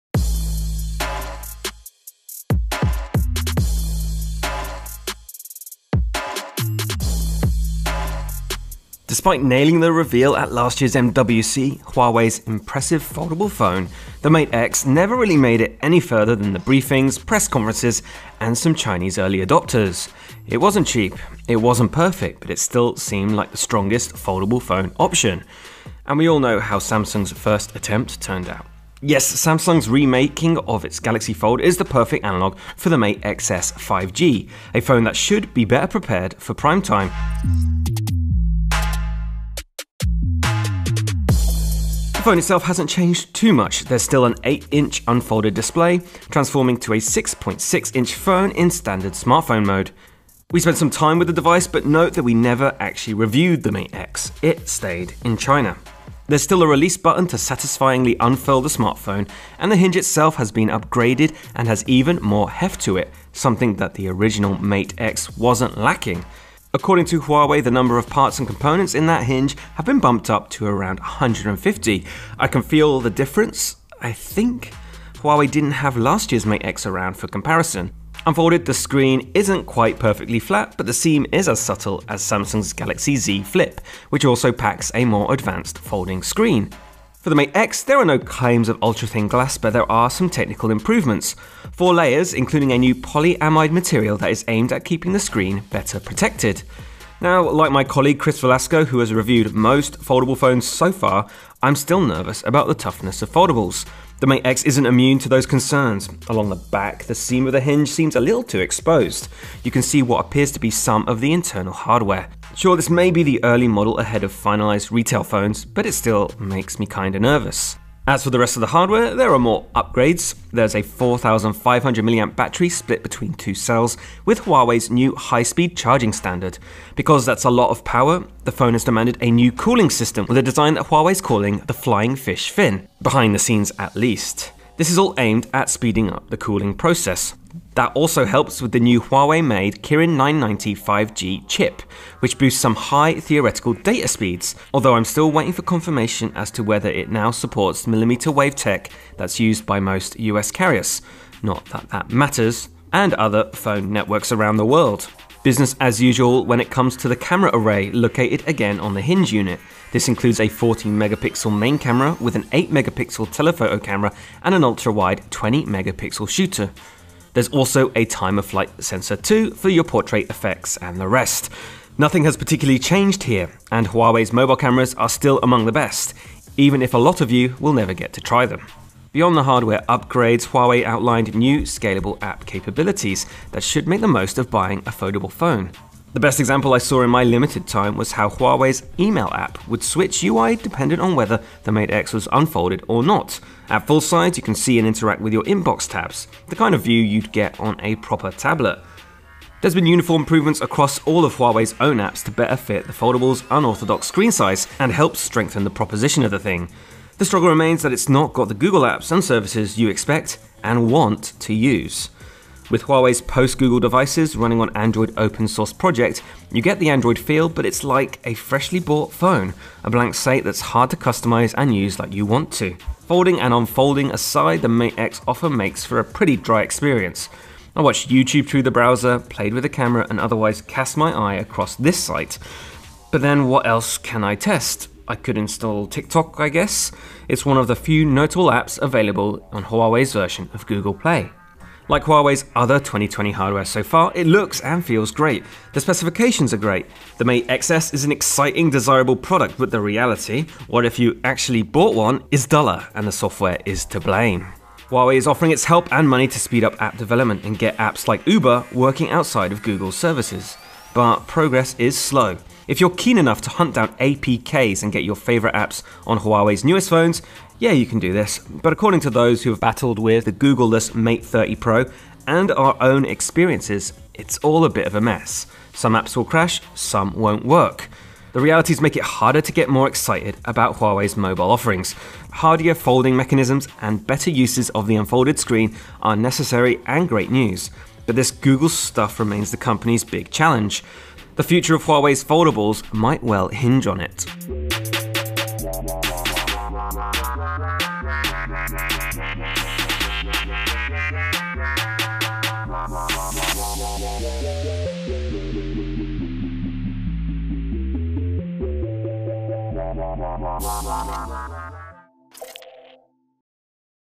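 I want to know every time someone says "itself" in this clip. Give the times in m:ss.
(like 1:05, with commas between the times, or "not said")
0:42, 0:59.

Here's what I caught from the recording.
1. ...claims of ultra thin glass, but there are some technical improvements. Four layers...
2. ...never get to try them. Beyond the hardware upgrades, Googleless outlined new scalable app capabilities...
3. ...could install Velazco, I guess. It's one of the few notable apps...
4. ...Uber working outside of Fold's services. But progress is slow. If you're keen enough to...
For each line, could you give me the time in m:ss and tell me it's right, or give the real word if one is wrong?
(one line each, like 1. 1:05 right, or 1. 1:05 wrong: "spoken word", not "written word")
1. 1:28 right
2. 2:57 wrong: "Huawei", not "Googleless"
3. 3:55 wrong: "TikTok", not "Velazco"
4. 4:18 wrong: "Google", not "Fold".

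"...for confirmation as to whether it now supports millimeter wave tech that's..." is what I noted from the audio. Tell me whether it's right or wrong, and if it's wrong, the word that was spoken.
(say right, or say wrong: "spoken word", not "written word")
right.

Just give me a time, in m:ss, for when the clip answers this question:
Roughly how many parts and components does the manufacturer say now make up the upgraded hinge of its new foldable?
1:11.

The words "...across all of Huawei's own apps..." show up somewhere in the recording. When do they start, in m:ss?
3:20.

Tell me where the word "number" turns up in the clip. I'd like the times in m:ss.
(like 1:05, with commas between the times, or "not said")
1:07.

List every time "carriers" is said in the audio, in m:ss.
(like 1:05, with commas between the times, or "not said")
2:30.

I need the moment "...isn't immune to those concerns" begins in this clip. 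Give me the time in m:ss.
1:44.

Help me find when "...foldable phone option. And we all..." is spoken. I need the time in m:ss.
0:24.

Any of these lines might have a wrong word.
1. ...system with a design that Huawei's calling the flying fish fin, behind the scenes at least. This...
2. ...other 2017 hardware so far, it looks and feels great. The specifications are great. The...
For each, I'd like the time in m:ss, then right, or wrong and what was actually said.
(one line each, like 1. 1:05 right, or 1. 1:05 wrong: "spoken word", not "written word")
1. 2:09 right
2. 4:02 wrong: "2020", not "2017".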